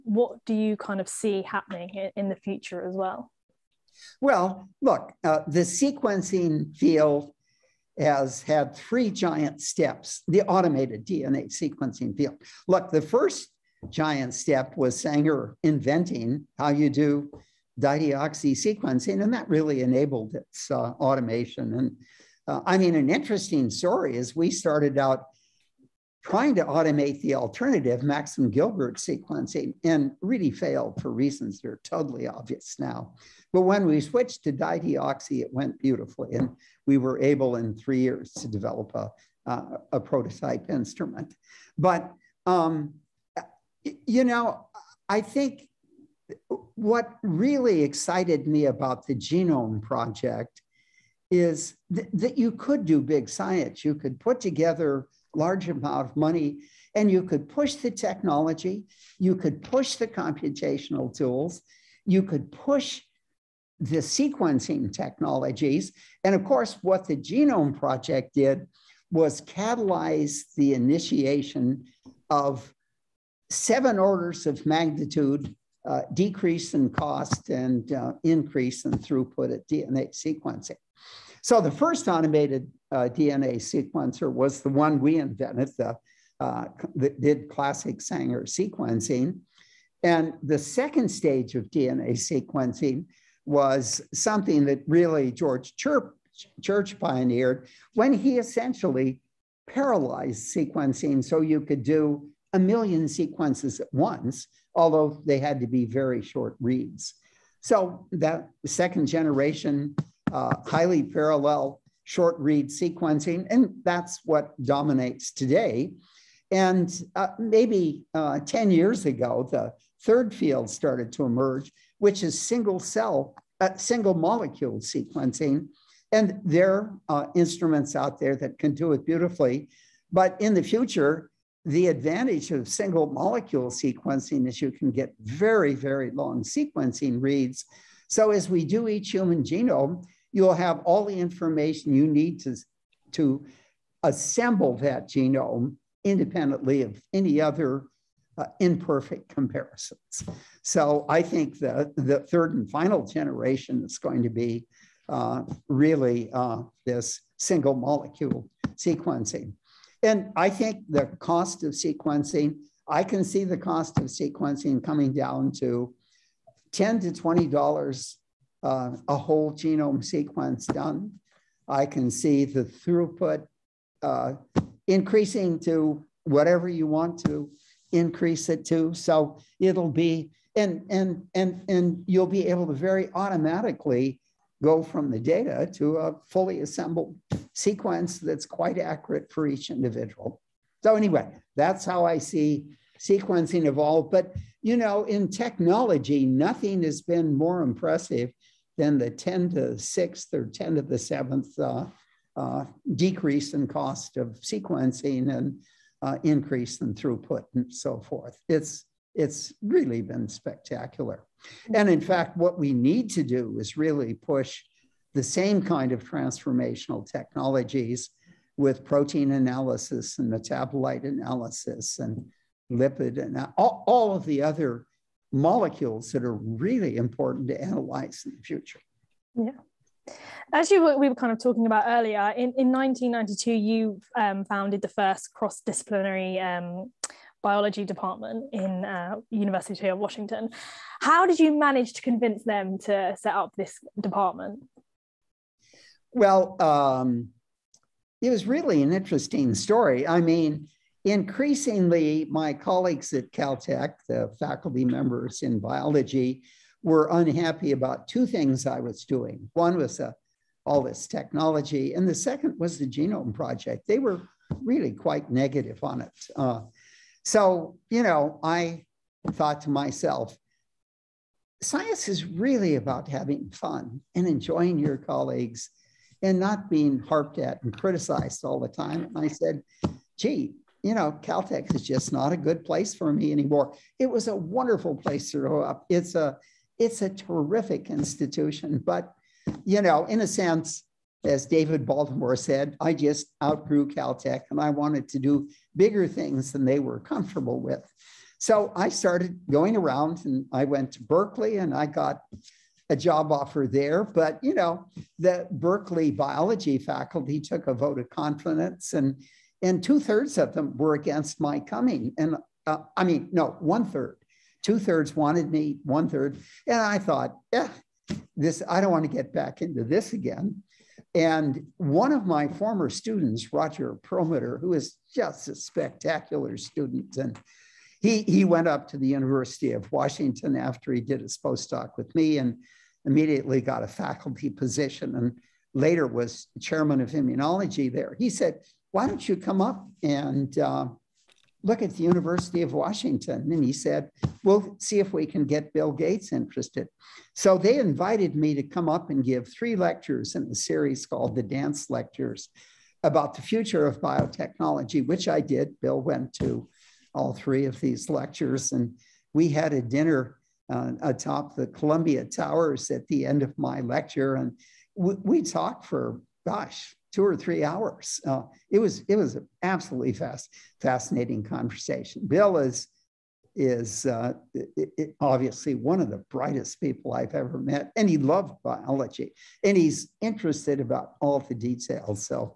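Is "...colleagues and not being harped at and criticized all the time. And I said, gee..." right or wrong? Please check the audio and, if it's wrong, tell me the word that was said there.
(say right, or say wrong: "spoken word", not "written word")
right.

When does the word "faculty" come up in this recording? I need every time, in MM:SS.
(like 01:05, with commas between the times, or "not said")
04:14, 05:06, 05:33.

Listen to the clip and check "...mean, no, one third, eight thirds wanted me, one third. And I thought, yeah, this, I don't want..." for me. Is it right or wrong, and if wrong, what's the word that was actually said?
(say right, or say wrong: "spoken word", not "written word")
wrong: "two", not "eight".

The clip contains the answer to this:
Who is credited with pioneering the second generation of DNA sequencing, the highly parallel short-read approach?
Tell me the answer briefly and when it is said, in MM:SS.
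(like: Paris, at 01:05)
George Church, at 01:35.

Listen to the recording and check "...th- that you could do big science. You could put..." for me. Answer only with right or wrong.
right.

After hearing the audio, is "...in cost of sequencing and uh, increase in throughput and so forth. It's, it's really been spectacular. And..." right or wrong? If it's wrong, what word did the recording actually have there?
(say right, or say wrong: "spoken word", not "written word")
right.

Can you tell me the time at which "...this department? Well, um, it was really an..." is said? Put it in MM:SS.
04:03.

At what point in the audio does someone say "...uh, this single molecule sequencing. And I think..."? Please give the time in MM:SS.
02:36.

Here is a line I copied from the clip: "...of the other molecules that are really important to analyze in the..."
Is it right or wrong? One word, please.
right.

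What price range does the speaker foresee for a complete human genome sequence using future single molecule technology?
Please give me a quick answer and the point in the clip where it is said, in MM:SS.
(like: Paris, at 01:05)
$10 to $20, at 02:46.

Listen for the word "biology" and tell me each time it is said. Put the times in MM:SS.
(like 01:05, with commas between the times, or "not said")
03:57, 04:15, 05:06, 06:18.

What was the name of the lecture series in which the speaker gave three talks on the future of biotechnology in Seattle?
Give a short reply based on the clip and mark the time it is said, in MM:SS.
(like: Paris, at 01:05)
Danz Lectures, at 05:51.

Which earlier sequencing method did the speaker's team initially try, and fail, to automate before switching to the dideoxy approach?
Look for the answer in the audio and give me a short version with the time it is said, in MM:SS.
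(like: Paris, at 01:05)
Maxam Gilbert sequencing, at 00:28.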